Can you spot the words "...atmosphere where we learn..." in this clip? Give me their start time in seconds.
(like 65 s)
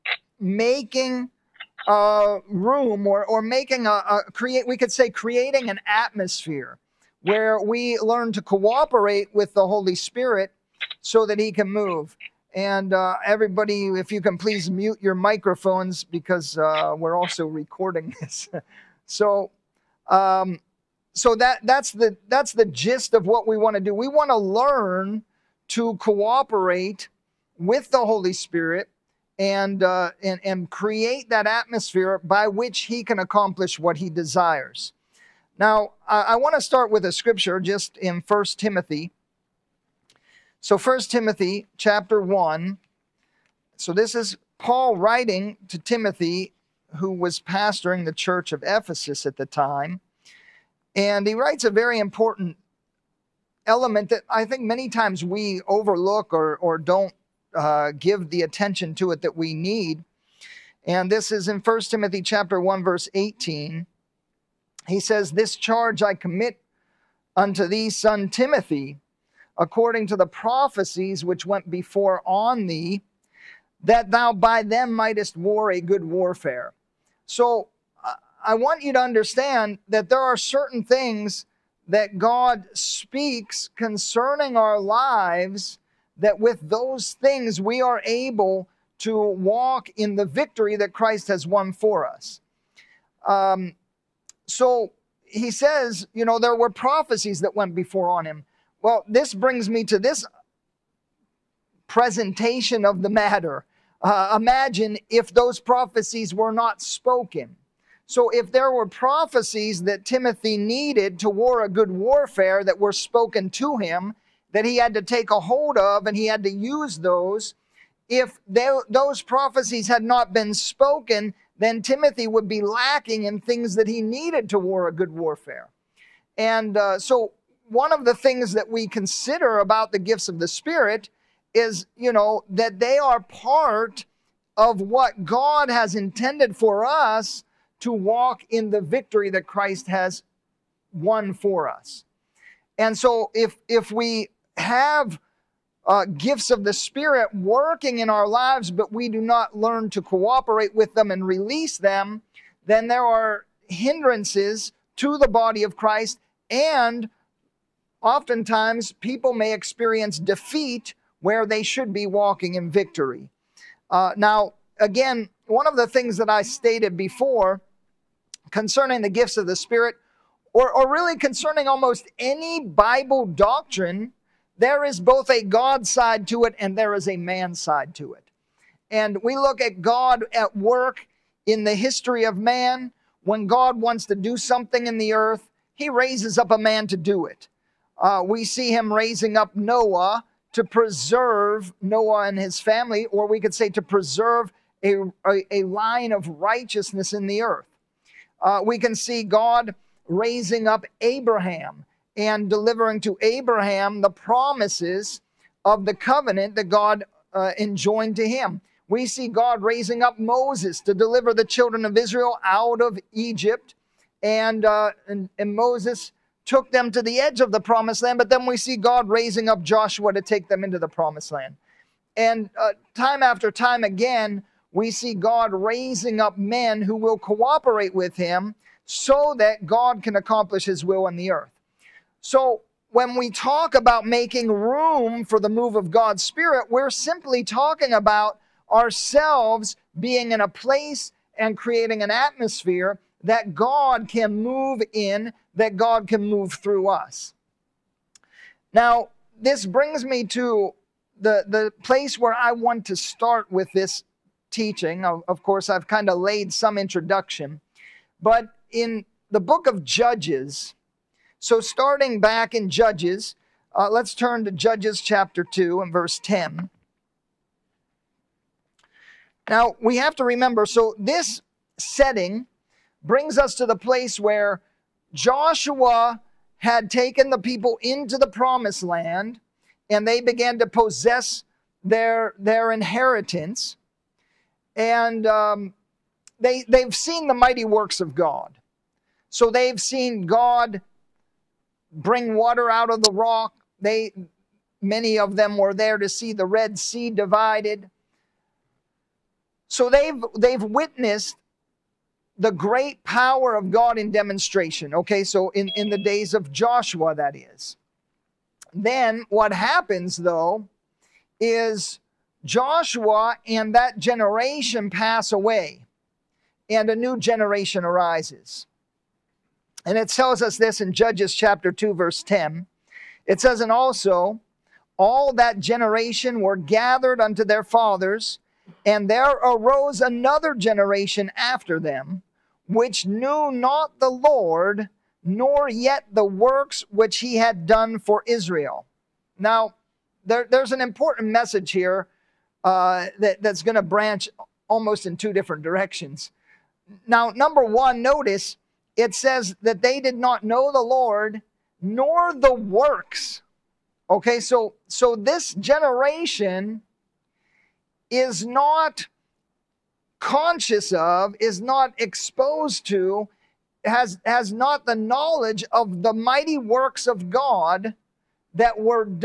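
5 s.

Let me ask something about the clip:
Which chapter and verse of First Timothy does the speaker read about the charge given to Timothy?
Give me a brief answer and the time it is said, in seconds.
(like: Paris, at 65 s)
Chapter 1 verse 18, at 61 s.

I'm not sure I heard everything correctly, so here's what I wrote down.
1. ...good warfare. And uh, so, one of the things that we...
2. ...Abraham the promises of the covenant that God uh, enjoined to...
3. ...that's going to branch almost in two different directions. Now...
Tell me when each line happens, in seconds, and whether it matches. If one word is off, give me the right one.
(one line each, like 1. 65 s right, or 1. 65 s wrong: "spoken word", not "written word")
1. 124 s right
2. 203 s right
3. 343 s right.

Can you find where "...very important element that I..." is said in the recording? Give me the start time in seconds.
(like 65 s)
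51 s.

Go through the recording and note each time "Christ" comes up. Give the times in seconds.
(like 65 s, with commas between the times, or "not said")
90 s, 139 s, 155 s.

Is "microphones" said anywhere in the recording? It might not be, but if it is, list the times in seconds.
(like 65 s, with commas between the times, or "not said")
15 s.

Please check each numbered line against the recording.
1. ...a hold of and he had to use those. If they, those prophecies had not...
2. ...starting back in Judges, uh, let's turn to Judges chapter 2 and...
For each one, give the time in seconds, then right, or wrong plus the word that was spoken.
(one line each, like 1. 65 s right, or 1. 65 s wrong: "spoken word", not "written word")
1. 115 s right
2. 261 s right.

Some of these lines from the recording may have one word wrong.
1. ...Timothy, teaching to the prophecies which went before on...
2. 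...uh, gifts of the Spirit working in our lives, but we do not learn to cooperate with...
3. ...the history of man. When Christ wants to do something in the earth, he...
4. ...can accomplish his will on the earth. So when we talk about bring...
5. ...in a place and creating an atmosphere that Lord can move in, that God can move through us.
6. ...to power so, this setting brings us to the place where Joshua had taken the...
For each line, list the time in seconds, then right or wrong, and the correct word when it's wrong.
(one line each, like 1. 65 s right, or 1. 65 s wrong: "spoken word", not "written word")
1. 68 s wrong: "according", not "teaching"
2. 145 s right
3. 181 s wrong: "God", not "Christ"
4. 230 s wrong: "making", not "bring"
5. 240 s wrong: "God", not "Lord"
6. 270 s wrong: "remember", not "power".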